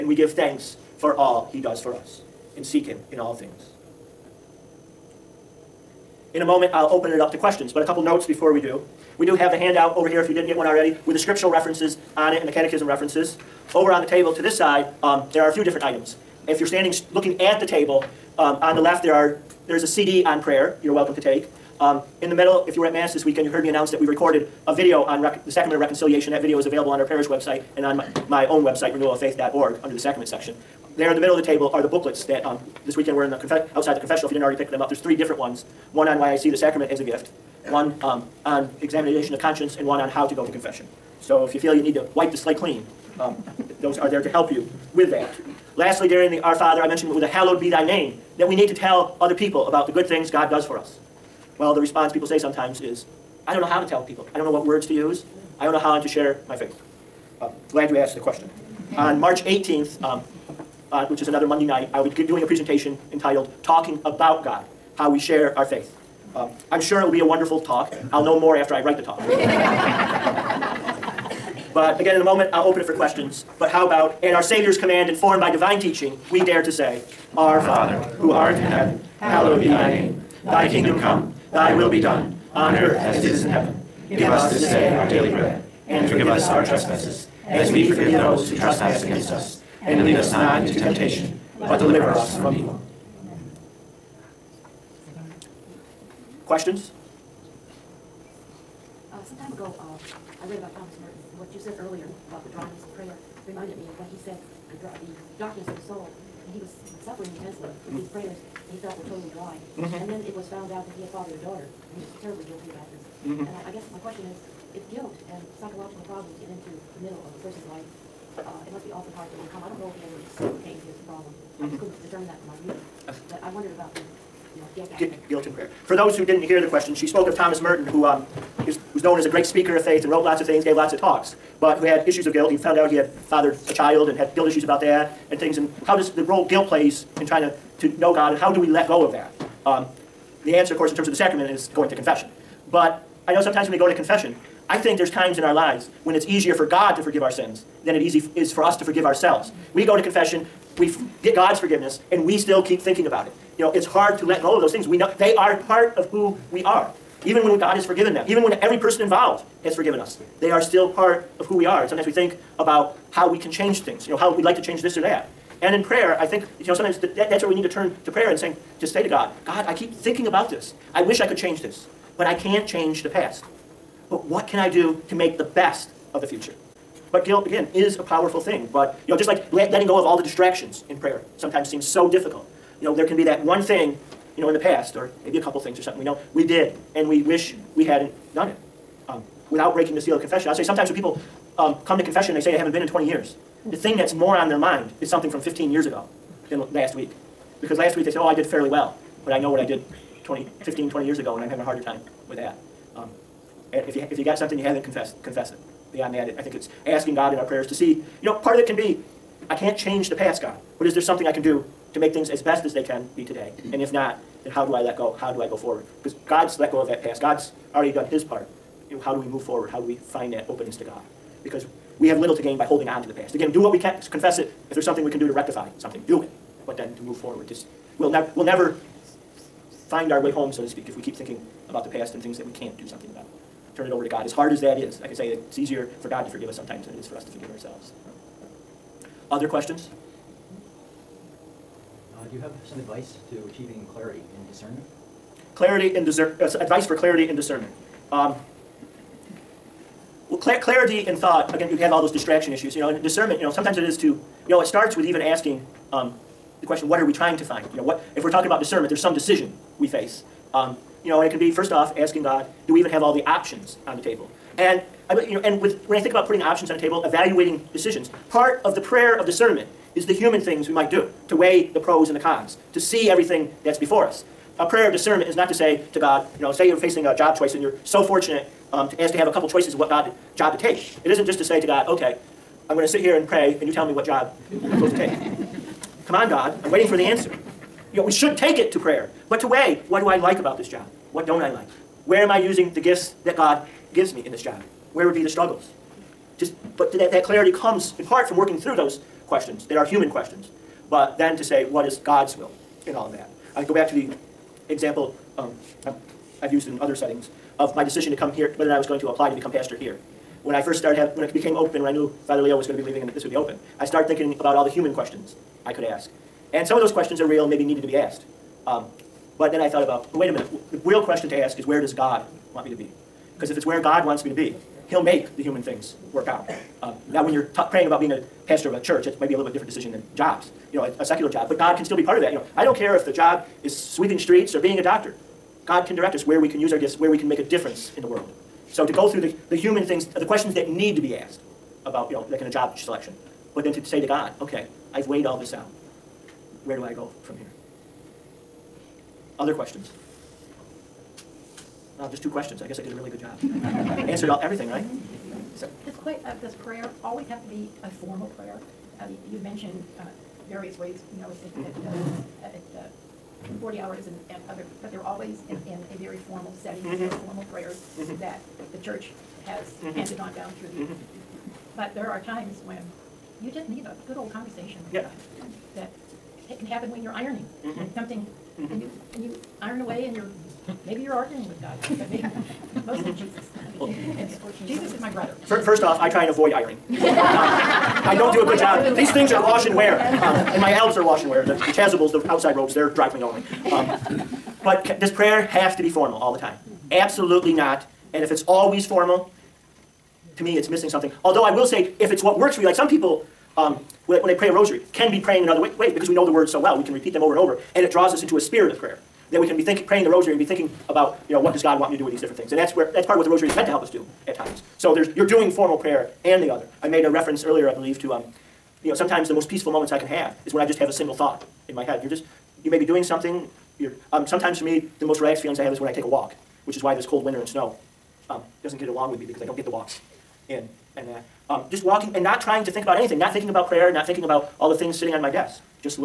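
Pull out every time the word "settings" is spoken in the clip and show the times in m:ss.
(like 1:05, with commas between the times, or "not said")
5:06, 6:06.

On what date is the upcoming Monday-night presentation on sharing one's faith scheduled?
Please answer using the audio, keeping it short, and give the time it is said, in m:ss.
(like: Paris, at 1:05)
March 18th, at 0:59.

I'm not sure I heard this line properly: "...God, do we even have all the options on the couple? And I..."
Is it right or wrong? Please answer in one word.
wrong.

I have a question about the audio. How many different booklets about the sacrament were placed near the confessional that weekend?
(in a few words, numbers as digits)
3.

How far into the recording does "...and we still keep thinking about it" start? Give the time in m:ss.
2:32.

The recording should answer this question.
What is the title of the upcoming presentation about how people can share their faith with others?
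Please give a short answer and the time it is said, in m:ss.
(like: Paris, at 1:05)
Talking About God, at 1:03.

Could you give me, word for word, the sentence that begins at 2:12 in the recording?
He found out he had fathered a child and had guilt issues about that and things.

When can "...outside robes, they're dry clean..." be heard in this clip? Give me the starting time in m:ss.
6:32.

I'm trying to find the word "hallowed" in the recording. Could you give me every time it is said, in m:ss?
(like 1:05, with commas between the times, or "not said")
0:47, 1:19.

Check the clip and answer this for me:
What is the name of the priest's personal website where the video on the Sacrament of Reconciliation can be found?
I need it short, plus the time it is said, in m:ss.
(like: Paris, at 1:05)
renewaloffaith.org, at 0:28.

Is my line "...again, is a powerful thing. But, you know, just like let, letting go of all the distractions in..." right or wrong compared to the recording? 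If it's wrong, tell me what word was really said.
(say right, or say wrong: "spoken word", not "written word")
right.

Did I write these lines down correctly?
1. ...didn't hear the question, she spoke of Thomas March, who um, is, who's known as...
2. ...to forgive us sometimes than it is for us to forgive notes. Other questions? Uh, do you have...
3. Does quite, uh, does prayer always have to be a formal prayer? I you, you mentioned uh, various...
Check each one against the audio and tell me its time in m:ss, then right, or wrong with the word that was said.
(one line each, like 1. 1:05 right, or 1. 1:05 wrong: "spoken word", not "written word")
1. 2:06 wrong: "Merton", not "March"
2. 3:56 wrong: "ourselves", not "notes"
3. 5:55 right.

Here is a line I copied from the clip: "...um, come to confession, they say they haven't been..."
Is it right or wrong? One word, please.
right.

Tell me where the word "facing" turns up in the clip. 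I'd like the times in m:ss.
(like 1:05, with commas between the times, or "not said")
4:36.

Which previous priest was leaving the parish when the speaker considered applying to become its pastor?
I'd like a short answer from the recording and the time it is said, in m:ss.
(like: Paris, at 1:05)
Father Leo, at 5:12.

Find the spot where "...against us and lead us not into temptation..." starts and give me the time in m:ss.
1:29.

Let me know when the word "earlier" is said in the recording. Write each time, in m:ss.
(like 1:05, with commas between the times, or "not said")
1:41, 6:57.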